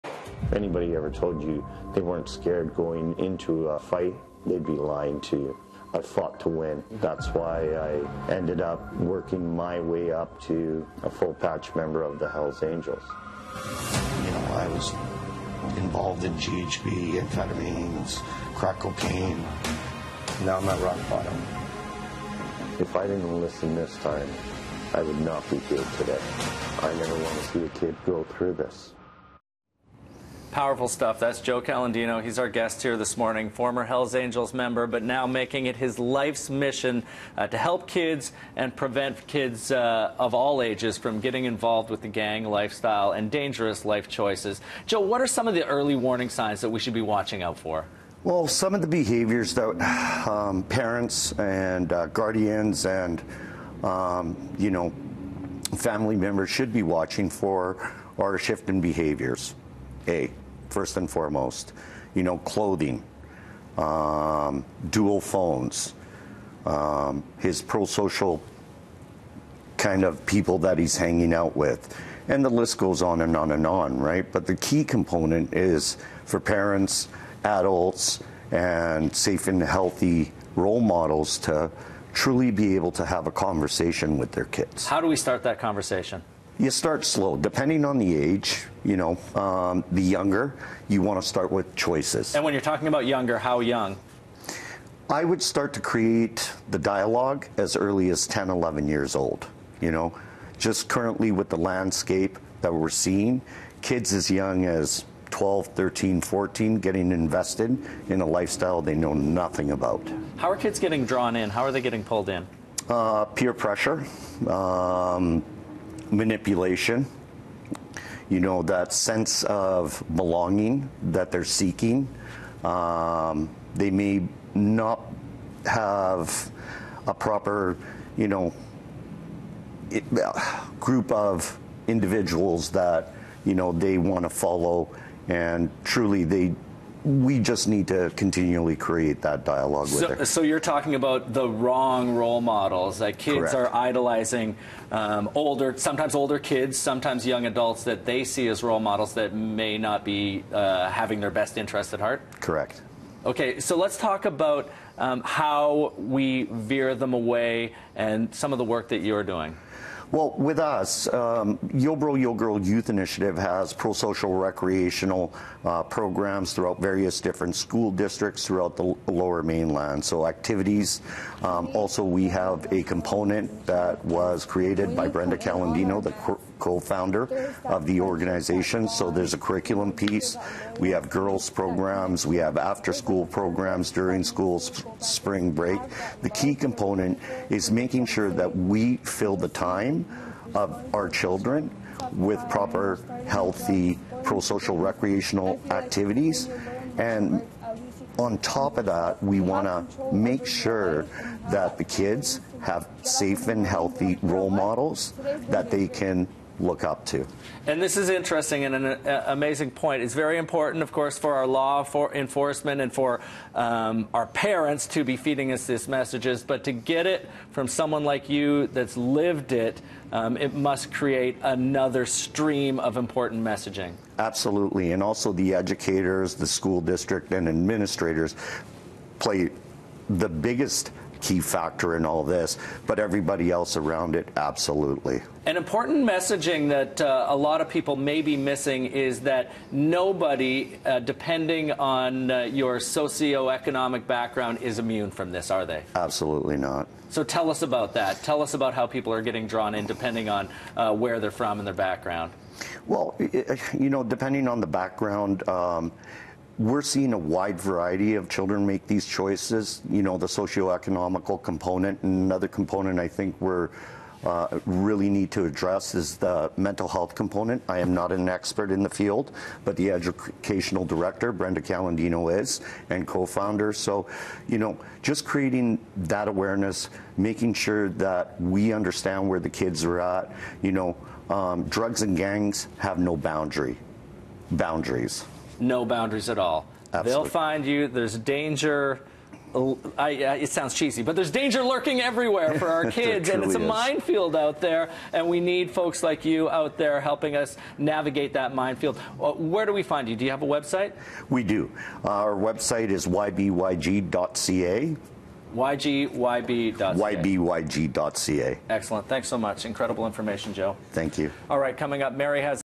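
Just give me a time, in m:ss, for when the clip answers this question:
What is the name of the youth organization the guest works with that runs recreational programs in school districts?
2:41.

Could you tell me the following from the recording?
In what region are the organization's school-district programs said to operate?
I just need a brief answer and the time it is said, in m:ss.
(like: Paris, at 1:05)
lower mainland, at 2:49.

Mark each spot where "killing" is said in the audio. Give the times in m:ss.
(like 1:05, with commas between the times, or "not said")
not said.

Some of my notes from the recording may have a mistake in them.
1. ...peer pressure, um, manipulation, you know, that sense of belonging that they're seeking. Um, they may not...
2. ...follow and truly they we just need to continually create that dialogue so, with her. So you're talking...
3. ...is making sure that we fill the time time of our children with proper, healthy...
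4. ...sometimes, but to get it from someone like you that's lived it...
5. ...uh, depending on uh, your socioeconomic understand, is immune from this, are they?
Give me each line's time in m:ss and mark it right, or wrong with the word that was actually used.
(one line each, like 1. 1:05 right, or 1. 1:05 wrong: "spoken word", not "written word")
1. 1:53 right
2. 2:14 right
3. 3:07 right
4. 3:35 wrong: "messages", not "sometimes"
5. 4:00 wrong: "background", not "understand".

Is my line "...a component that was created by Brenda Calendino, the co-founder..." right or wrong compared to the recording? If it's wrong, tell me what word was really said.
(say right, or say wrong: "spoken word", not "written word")
right.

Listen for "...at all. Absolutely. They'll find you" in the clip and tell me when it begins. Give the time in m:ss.
4:46.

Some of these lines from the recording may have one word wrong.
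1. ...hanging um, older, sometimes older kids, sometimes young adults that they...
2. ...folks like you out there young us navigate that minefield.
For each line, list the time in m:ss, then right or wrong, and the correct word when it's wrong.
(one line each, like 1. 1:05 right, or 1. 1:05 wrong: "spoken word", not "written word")
1. 2:23 wrong: "idolizing", not "hanging"
2. 4:55 wrong: "helping", not "young".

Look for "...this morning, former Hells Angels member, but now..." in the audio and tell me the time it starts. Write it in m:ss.
0:32.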